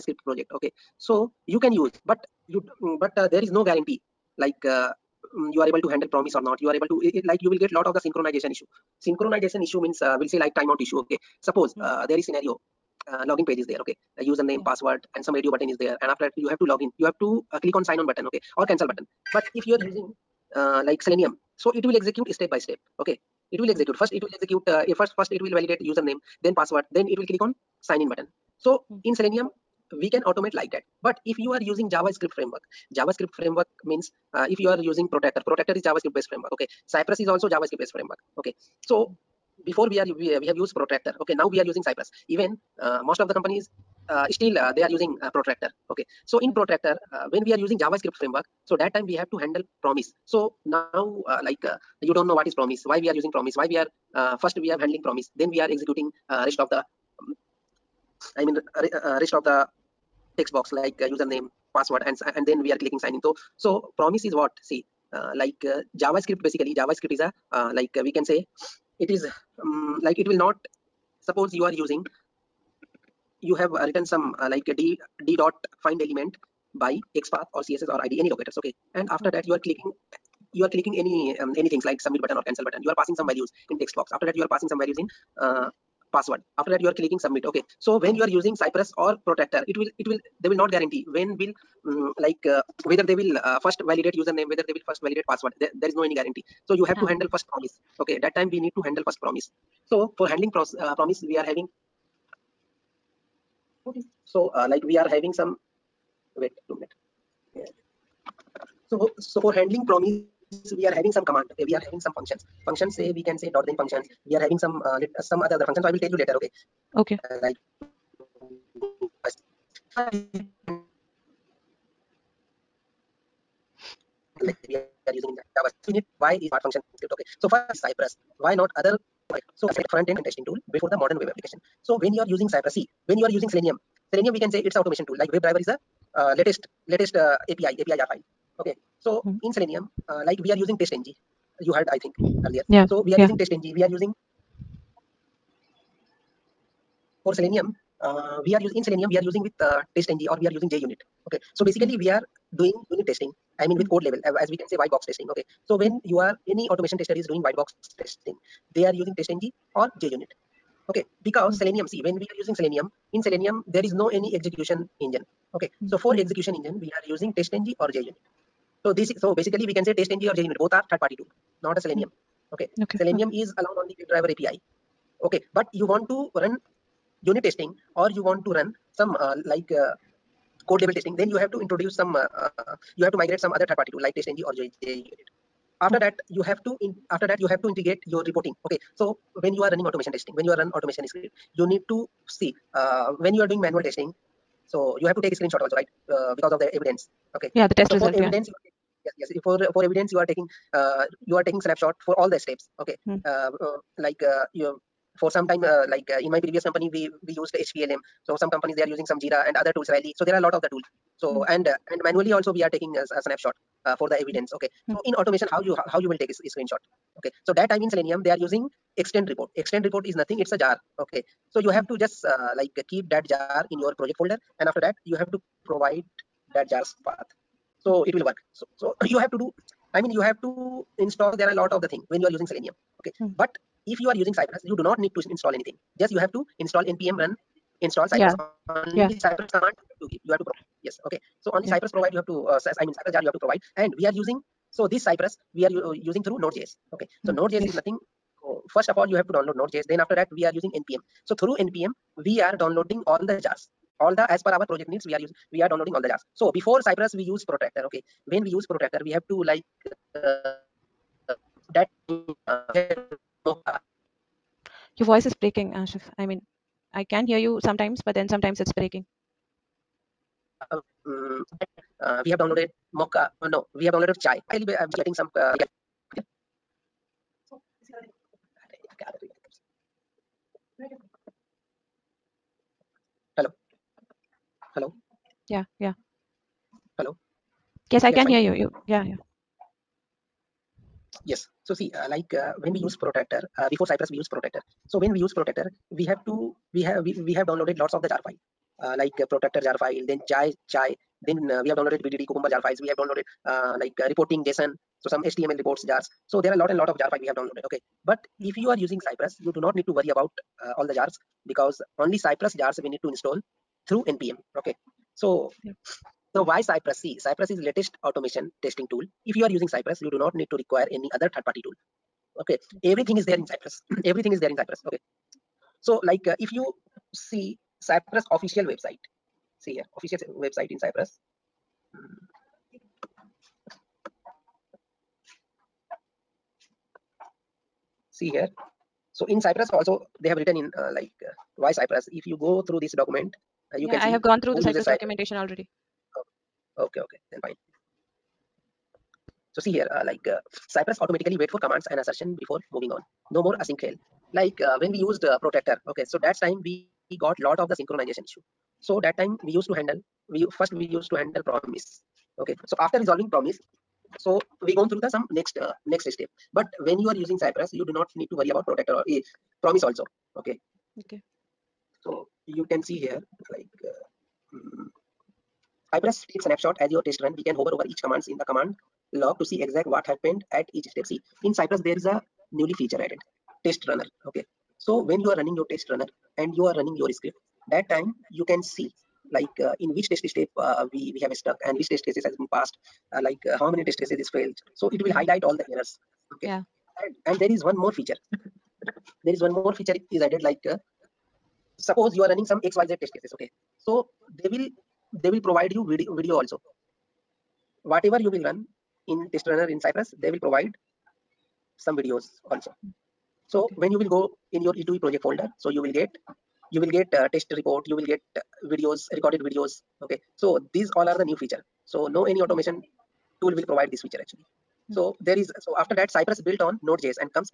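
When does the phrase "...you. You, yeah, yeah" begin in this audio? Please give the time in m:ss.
4:48.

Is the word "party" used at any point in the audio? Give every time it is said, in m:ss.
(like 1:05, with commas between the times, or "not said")
2:50, 3:03, 5:21.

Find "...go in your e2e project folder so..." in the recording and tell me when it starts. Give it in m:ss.
6:54.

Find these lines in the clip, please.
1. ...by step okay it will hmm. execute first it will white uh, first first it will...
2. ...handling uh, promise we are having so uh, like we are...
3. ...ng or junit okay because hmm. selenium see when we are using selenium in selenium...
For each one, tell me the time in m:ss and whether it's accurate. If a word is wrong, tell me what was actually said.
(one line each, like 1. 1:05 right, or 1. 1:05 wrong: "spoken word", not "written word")
1. 0:22 wrong: "execute", not "white"
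2. 1:40 right
3. 2:39 right.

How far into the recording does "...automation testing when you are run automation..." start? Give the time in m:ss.
3:09.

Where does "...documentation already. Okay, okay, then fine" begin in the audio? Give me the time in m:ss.
5:44.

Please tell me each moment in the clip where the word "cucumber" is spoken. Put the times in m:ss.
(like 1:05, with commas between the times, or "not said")
5:02.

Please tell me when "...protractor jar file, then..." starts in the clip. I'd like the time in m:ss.
4:59.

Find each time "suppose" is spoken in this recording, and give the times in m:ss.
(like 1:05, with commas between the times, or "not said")
0:11, 1:11, 6:41.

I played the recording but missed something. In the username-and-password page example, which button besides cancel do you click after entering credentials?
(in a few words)
Sign on button.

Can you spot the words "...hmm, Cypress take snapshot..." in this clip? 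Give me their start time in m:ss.
6:14.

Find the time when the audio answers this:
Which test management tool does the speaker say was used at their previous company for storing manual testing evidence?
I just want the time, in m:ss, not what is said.
3:27.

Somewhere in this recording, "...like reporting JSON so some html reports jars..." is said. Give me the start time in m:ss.
5:03.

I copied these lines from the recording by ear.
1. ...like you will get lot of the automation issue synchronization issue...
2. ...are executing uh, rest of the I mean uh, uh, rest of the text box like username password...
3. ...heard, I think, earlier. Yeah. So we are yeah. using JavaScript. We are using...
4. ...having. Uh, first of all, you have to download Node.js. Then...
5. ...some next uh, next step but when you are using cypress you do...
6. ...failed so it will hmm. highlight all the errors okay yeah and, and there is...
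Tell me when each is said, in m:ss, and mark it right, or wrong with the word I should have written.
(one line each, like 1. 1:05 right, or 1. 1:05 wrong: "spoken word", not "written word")
1. 0:07 wrong: "synchronization", not "automation"
2. 0:55 right
3. 2:21 wrong: "TestNG", not "JavaScript"
4. 4:07 wrong: "nothing", not "having"
5. 6:05 right
6. 6:34 right.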